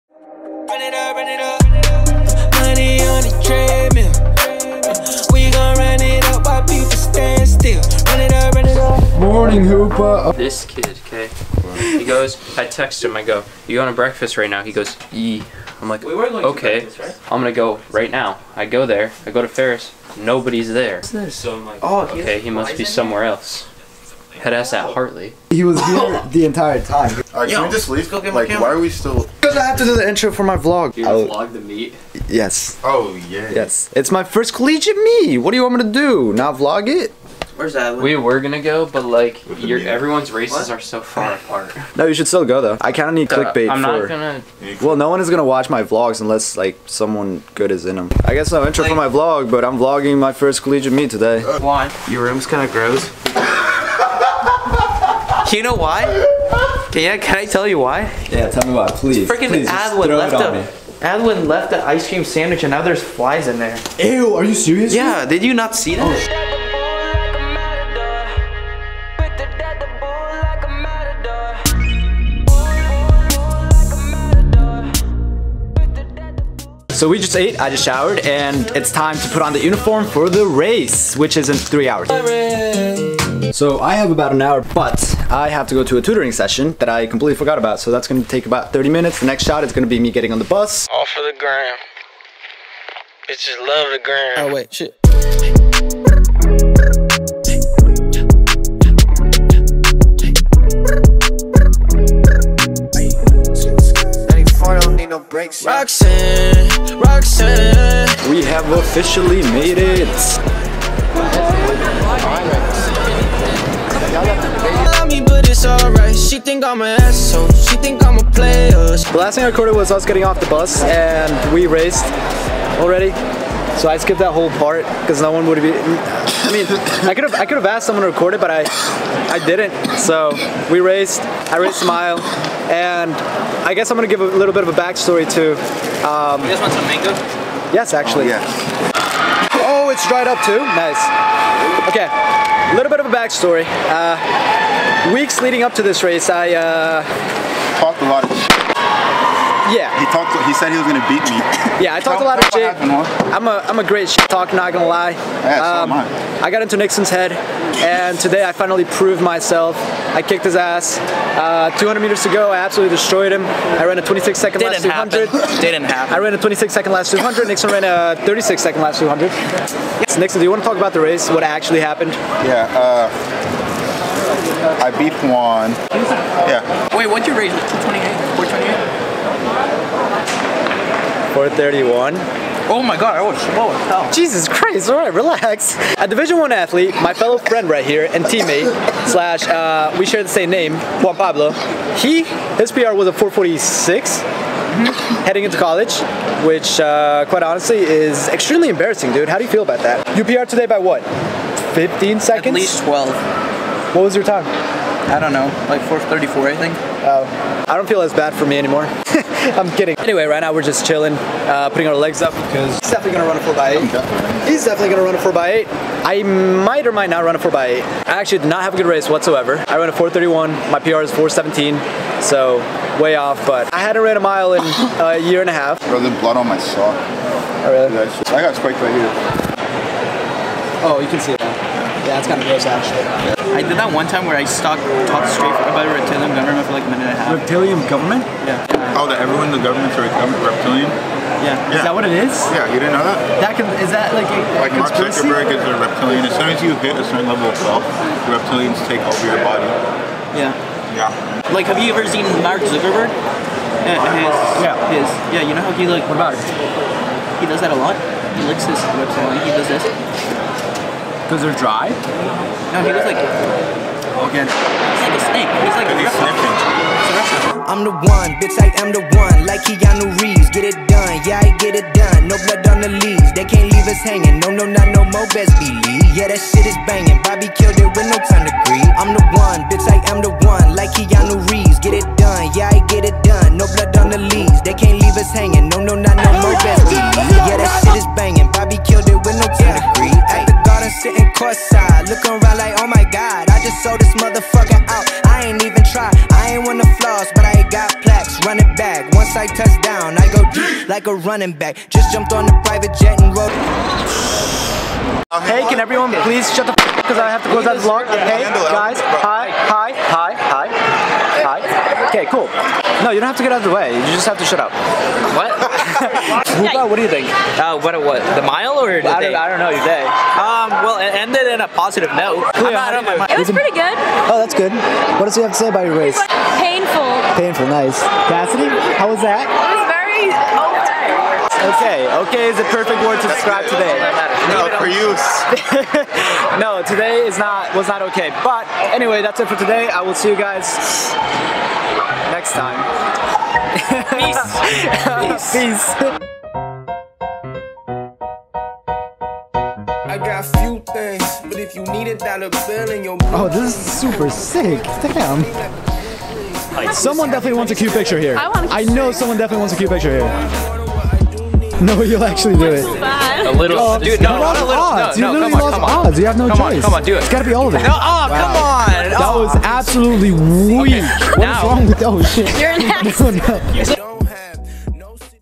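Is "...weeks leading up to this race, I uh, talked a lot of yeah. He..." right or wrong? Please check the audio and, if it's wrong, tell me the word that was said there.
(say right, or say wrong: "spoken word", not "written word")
right.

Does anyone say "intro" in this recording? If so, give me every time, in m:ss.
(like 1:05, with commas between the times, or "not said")
0:30, 0:48.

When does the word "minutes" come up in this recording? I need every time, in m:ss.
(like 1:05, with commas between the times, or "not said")
1:28, 3:56.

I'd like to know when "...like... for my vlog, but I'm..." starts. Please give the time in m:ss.
0:48.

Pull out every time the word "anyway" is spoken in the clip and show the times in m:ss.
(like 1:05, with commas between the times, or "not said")
3:29, 5:38.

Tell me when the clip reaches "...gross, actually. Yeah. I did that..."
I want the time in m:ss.
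3:52.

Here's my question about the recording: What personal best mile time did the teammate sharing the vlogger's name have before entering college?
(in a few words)
4:46.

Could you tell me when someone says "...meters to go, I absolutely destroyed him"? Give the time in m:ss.
2:42.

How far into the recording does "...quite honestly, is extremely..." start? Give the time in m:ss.
3:17.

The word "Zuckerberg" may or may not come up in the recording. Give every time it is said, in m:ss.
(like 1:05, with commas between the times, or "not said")
4:04, 4:12.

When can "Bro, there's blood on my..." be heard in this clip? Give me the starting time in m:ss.
3:45.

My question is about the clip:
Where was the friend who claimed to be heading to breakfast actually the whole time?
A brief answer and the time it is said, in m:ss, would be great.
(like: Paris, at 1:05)
Hartley, at 0:24.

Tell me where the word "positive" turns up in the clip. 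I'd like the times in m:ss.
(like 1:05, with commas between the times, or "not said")
5:21.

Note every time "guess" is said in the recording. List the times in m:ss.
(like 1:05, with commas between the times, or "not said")
0:48, 2:13.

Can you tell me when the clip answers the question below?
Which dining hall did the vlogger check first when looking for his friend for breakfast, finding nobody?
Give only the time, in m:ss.
0:19.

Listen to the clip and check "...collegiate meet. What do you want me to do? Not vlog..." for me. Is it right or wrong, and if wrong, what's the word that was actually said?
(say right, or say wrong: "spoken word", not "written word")
right.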